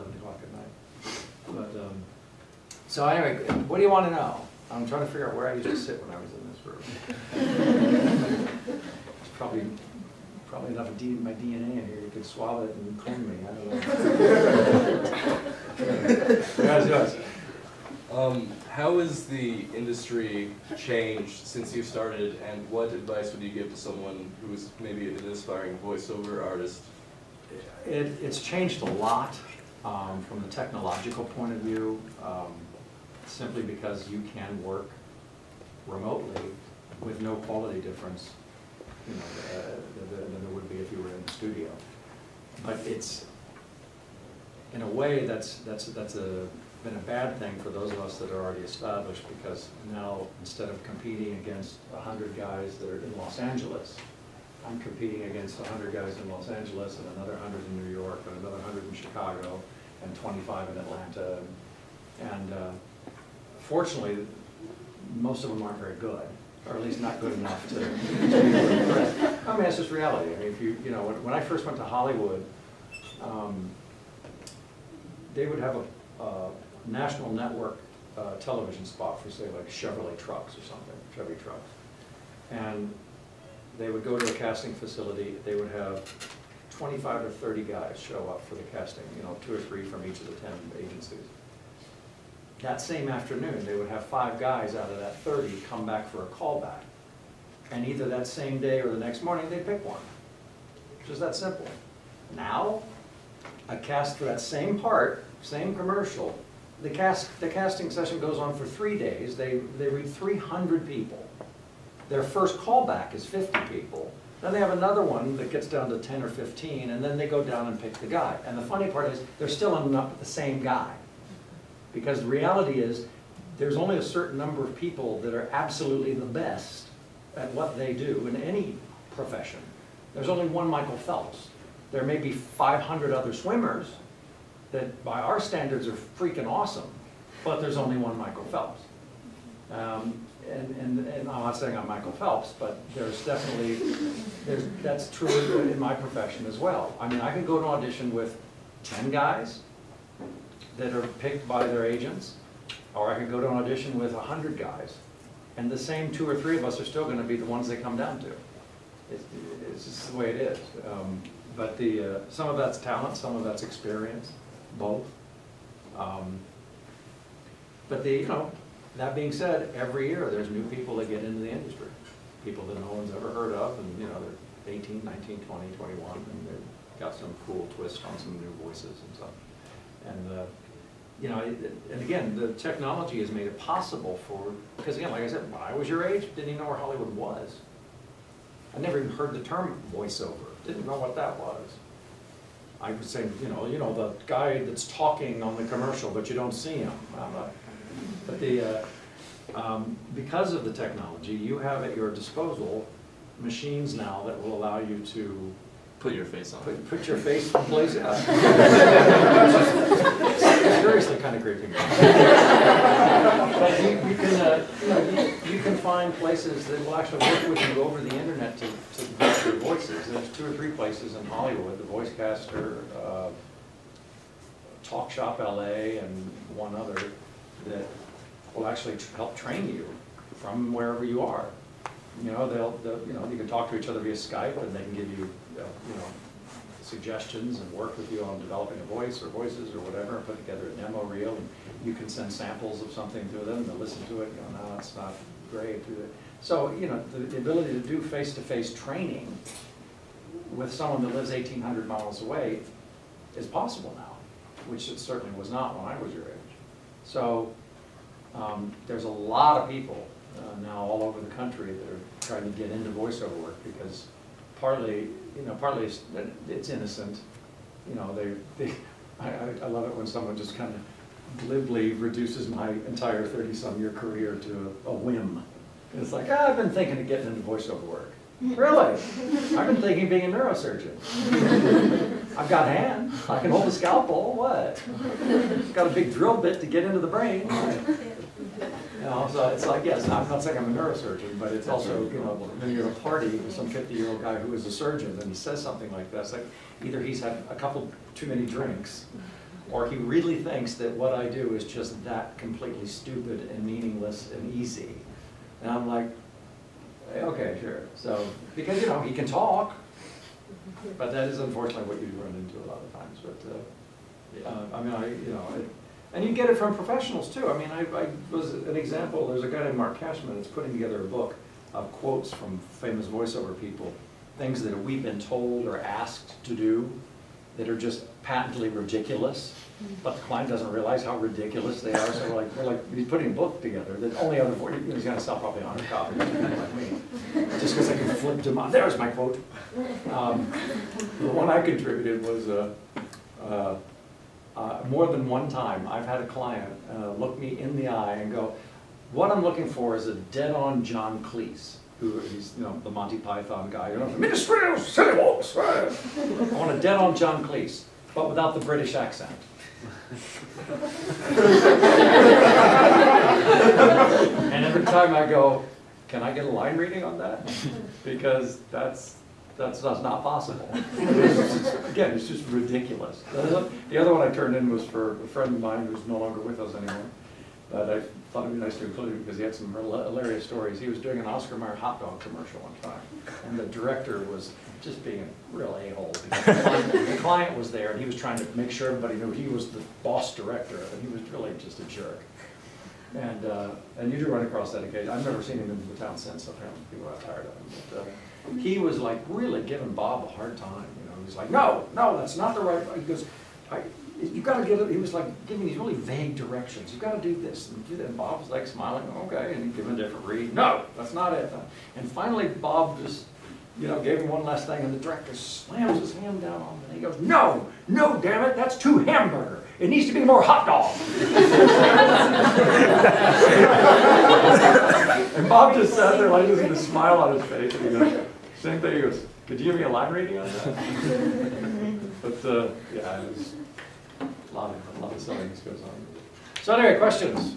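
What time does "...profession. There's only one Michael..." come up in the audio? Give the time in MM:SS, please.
02:09.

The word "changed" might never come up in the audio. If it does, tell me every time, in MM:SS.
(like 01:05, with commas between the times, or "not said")
00:20, 00:28.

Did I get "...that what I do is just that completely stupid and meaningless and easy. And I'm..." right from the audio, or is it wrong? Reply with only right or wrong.
right.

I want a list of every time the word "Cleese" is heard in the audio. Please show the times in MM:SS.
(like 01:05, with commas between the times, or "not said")
05:51, 05:57.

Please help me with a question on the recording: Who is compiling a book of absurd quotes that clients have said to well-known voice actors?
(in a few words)
Mark Cashman.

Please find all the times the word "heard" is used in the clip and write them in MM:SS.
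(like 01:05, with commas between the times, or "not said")
02:53, 03:09.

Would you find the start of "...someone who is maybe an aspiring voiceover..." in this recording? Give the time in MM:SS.
00:23.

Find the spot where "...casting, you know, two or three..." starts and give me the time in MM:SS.
01:28.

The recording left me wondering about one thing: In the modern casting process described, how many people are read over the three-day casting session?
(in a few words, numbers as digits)
300.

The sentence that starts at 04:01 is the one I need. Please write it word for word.
And you can send samples of something to them and they'll listen to it.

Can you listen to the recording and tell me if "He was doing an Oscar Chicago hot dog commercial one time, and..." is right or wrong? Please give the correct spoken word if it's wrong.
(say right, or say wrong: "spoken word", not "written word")
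wrong: "Mayer", not "Chicago".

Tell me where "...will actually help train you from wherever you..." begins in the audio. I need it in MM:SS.
03:48.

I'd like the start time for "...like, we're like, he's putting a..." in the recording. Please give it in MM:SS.
05:32.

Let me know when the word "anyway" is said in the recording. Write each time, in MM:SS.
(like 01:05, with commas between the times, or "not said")
00:03, 07:16.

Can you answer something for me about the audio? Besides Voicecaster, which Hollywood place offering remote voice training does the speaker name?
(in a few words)
Talk Shop LA.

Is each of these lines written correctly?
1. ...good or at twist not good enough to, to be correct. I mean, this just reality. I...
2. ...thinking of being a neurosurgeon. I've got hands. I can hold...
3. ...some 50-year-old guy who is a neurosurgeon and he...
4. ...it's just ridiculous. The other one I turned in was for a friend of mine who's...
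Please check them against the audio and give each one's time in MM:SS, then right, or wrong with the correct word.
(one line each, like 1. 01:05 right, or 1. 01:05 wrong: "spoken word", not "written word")
1. 01:05 wrong: "least", not "twist"
2. 04:39 right
3. 04:53 wrong: "surgeon", not "neurosurgeon"
4. 06:12 right.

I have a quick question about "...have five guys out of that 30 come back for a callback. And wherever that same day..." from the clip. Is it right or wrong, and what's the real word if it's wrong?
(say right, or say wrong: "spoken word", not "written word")
wrong: "either", not "wherever".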